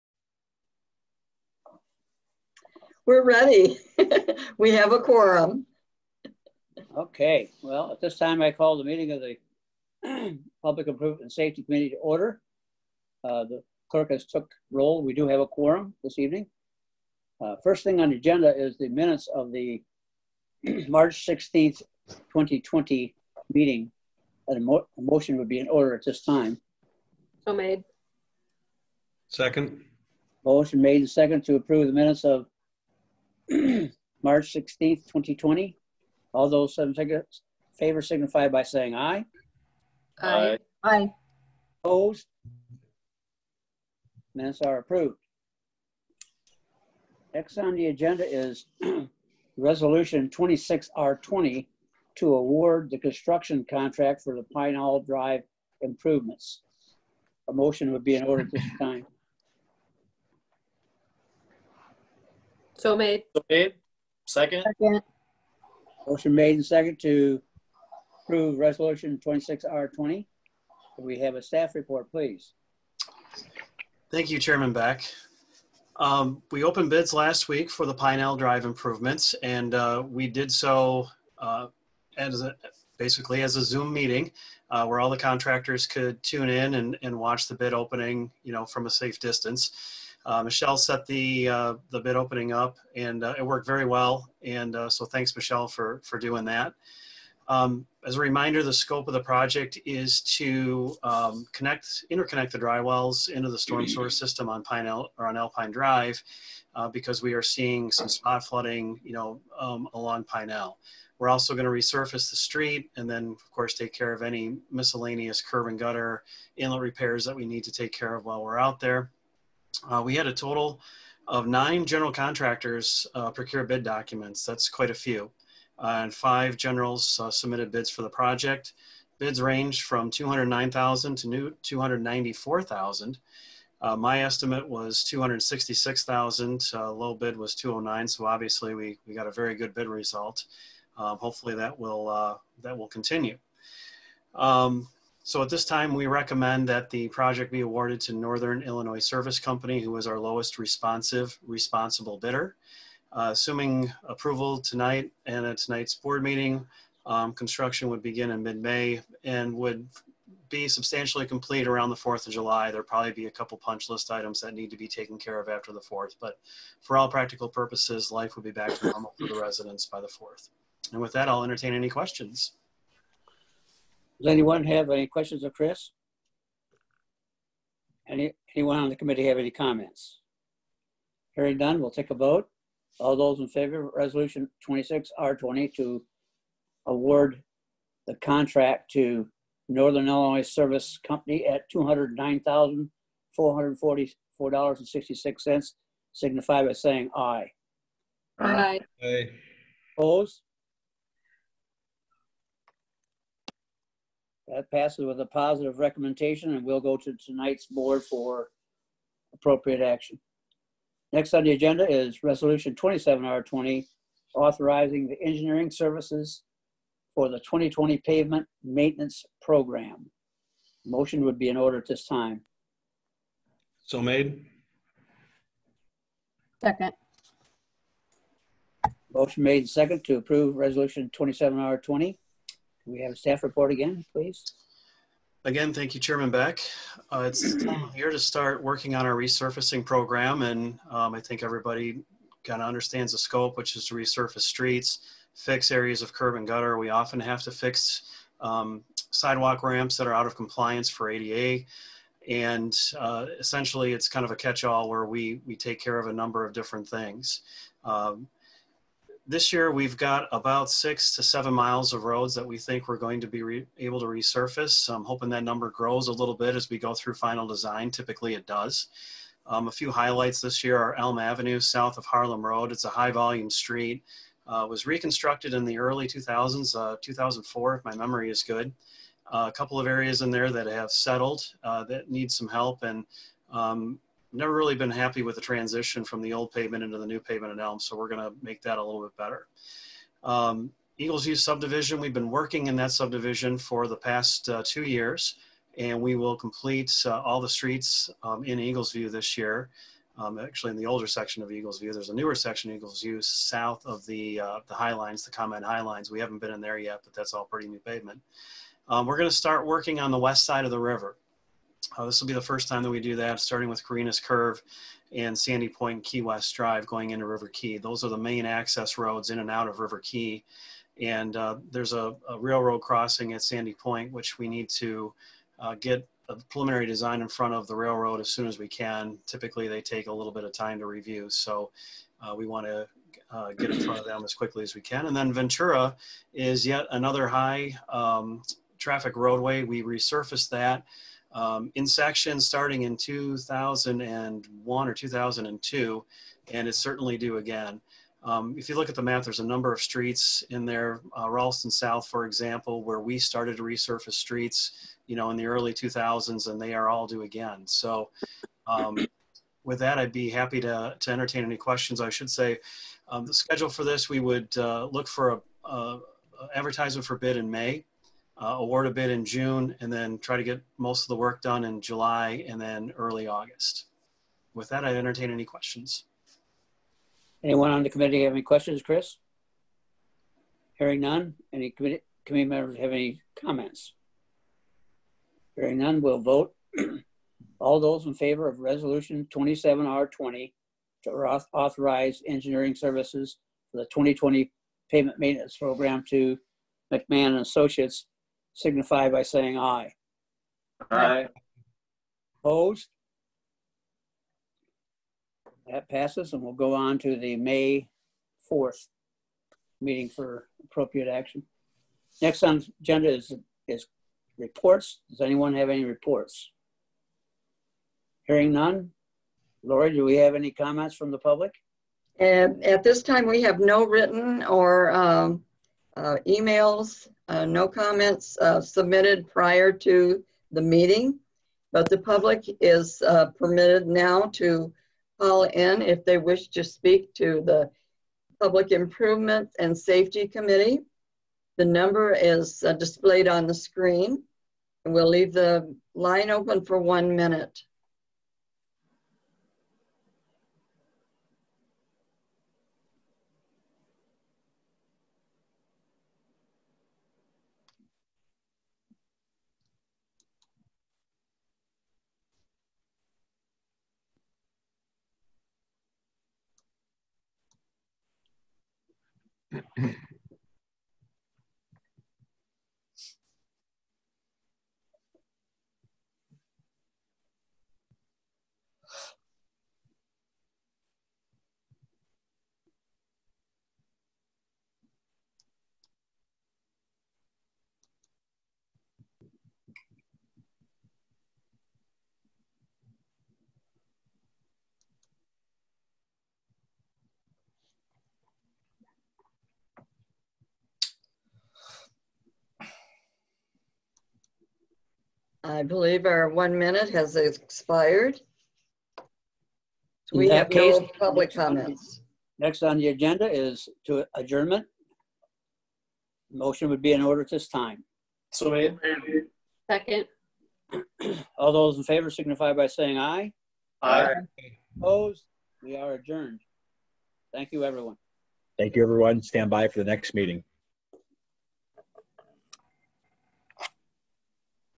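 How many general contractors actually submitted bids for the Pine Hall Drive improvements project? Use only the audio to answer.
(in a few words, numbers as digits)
5.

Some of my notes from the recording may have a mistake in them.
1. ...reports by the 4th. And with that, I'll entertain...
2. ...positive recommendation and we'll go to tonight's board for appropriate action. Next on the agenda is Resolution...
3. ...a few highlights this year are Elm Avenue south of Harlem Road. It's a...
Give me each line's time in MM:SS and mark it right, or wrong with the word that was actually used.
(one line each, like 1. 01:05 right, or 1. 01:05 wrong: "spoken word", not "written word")
1. 02:49 wrong: "residents", not "reports"
2. 03:25 right
3. 04:29 right.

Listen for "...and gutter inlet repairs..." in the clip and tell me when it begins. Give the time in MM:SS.
01:55.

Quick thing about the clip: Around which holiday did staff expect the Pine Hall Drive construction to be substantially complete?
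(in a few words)
4th of July.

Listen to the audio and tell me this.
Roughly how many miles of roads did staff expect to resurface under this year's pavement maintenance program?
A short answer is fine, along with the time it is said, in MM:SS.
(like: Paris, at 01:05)
6 to 7 miles, at 04:20.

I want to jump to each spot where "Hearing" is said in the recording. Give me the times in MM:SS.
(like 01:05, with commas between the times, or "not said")
03:01, 06:20, 06:25, 06:58.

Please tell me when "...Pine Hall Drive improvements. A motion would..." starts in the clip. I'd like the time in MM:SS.
00:54.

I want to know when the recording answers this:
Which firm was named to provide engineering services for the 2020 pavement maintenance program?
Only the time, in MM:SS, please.
06:36.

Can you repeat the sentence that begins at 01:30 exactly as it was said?
Uh, Michelle set the uh, the bid opening up, and uh, it worked very well.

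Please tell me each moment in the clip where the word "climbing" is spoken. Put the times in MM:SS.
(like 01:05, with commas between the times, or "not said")
not said.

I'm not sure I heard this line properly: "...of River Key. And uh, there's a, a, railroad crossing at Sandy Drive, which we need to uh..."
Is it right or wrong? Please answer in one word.
wrong.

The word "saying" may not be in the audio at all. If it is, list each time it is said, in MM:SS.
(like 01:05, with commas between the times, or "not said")
00:38, 03:16, 06:39, 08:42.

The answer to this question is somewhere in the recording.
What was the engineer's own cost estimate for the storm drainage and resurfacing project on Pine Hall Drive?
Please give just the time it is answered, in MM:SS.
02:15.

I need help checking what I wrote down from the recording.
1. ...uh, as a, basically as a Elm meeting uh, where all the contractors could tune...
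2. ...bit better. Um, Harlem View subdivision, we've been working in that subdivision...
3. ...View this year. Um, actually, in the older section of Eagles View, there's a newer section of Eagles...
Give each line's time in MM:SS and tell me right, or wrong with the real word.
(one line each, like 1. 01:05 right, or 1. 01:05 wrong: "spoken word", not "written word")
1. 01:21 wrong: "Zoom", not "Elm"
2. 04:49 wrong: "Eagles", not "Harlem"
3. 04:58 right.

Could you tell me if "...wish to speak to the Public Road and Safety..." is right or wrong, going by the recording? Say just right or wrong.
wrong.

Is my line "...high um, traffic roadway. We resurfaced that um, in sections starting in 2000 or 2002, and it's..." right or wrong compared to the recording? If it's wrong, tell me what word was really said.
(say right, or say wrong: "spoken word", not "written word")
wrong: "2001", not "2000".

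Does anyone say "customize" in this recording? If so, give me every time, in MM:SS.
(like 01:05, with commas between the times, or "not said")
not said.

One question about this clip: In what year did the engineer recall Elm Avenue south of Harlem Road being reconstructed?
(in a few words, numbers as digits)
2004.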